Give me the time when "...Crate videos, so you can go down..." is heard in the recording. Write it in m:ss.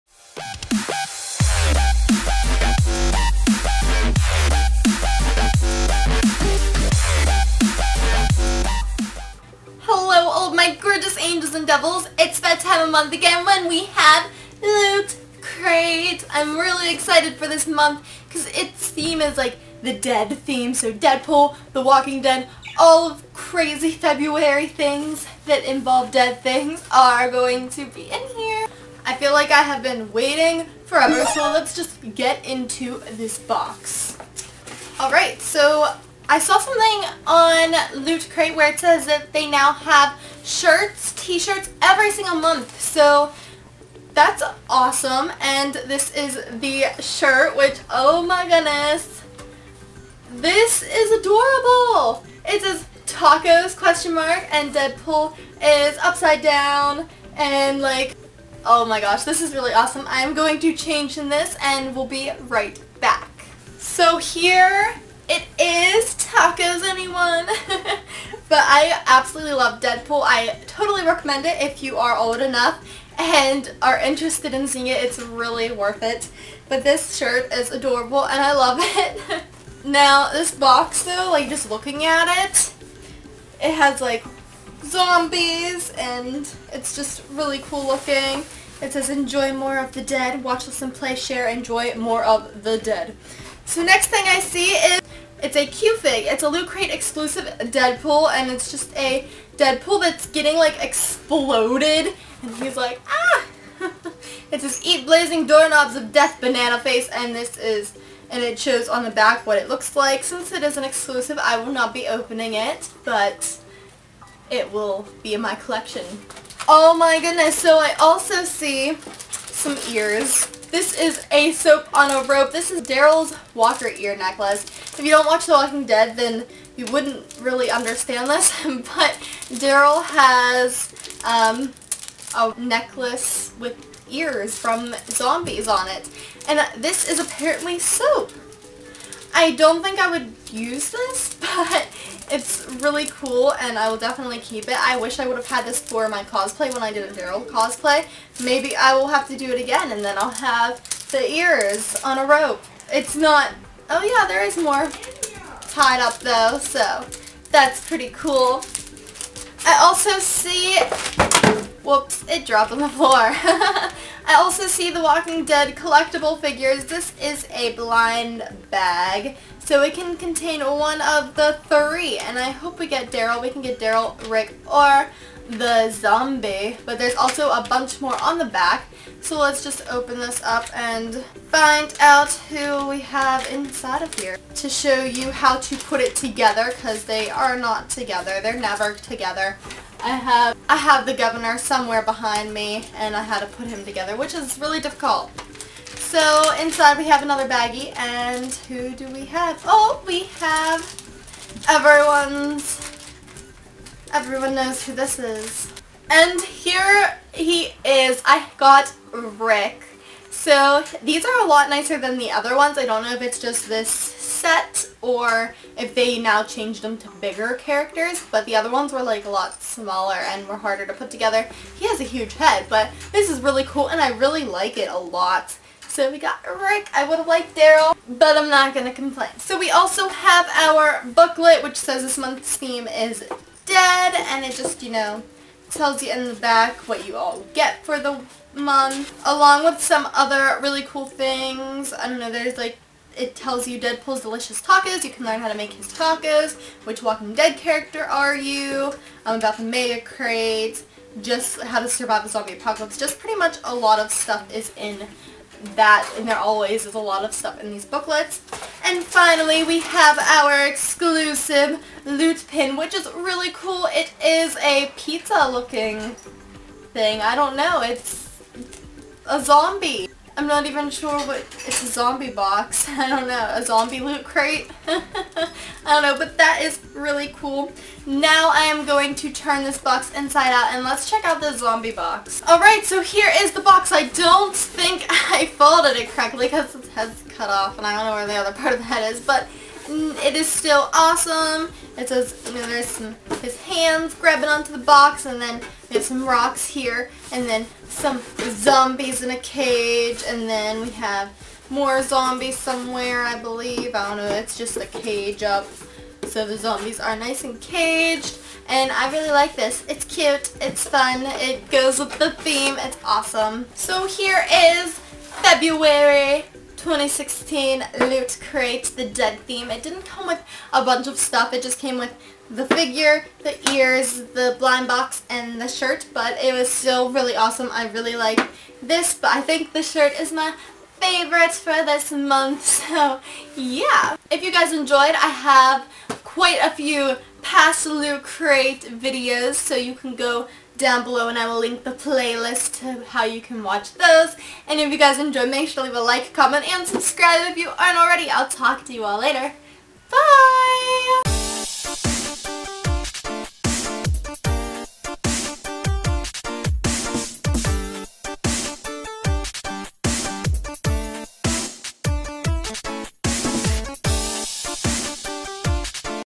5:38.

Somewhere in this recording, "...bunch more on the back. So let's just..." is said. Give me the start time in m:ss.
2:57.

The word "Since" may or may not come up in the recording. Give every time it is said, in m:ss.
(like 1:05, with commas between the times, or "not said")
1:50.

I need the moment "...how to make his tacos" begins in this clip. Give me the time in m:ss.
4:05.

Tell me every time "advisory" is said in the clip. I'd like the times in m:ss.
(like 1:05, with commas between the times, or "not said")
not said.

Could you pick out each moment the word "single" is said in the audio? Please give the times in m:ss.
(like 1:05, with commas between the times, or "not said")
0:42.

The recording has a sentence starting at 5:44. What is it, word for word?
And if you guys enjoy, make sure to leave a like, comment, and subscribe if you aren't already.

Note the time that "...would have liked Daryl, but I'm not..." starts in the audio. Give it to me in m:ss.
3:47.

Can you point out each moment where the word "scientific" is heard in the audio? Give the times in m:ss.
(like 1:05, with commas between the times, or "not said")
not said.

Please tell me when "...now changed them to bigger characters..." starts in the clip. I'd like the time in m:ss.
3:36.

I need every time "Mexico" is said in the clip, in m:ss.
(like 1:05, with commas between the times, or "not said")
not said.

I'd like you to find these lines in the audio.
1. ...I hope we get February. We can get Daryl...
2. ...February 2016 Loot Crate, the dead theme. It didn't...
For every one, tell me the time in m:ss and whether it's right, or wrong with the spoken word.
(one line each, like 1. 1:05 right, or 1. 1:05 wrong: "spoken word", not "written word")
1. 2:52 wrong: "Daryl", not "February"
2. 5:15 right.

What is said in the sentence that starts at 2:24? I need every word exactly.
I wish I would have had this for my cosplay when I did a Daryl cosplay.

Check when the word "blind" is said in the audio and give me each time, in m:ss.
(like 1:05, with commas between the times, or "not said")
2:47, 5:24.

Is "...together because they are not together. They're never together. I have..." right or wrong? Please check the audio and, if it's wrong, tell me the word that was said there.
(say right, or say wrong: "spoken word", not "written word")
right.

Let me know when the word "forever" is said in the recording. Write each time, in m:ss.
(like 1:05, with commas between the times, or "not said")
0:30.